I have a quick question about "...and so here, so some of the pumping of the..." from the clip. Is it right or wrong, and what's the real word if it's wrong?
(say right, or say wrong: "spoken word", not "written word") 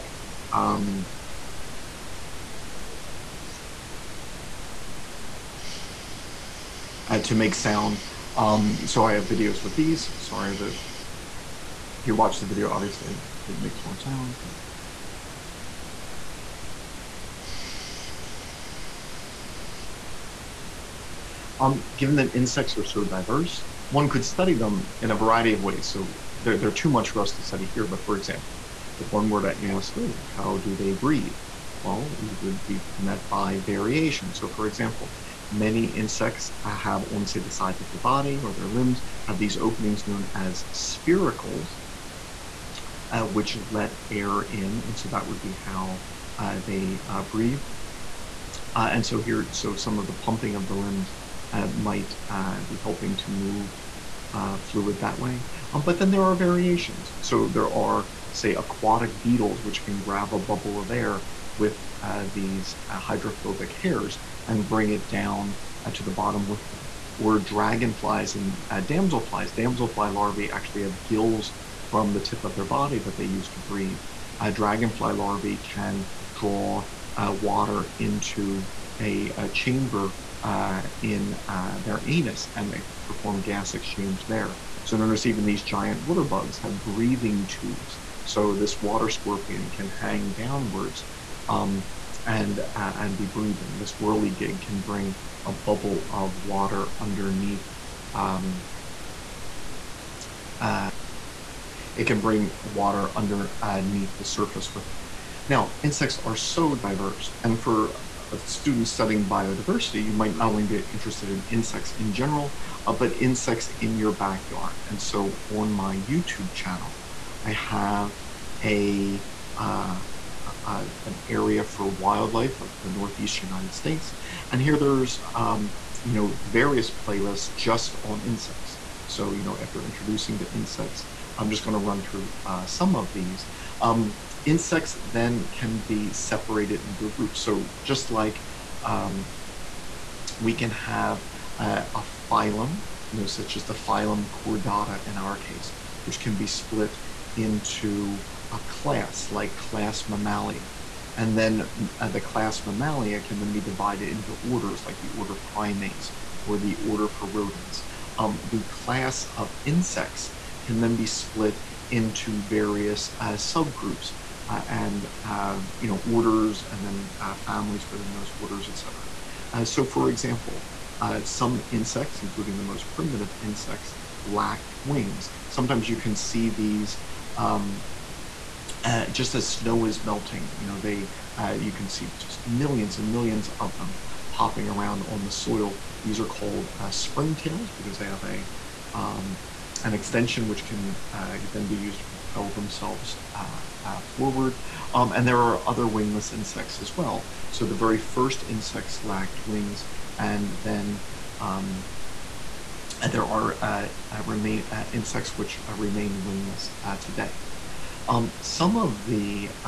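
right.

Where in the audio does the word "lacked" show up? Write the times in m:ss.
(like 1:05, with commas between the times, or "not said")
2:54, 3:19.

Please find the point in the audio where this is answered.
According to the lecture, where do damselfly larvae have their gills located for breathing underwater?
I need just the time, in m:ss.
1:12.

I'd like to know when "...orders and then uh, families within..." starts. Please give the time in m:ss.
2:46.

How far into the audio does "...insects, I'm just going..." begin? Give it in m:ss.
2:10.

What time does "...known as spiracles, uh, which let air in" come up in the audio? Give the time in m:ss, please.
0:40.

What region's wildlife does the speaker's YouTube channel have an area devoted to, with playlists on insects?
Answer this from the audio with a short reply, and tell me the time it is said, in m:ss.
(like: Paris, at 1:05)
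Northeast United States, at 2:02.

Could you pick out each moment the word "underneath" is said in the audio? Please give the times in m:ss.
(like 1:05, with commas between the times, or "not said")
1:36, 1:43.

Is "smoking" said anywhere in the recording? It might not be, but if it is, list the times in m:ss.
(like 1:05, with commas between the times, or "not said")
not said.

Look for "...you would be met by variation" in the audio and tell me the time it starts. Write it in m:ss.
0:32.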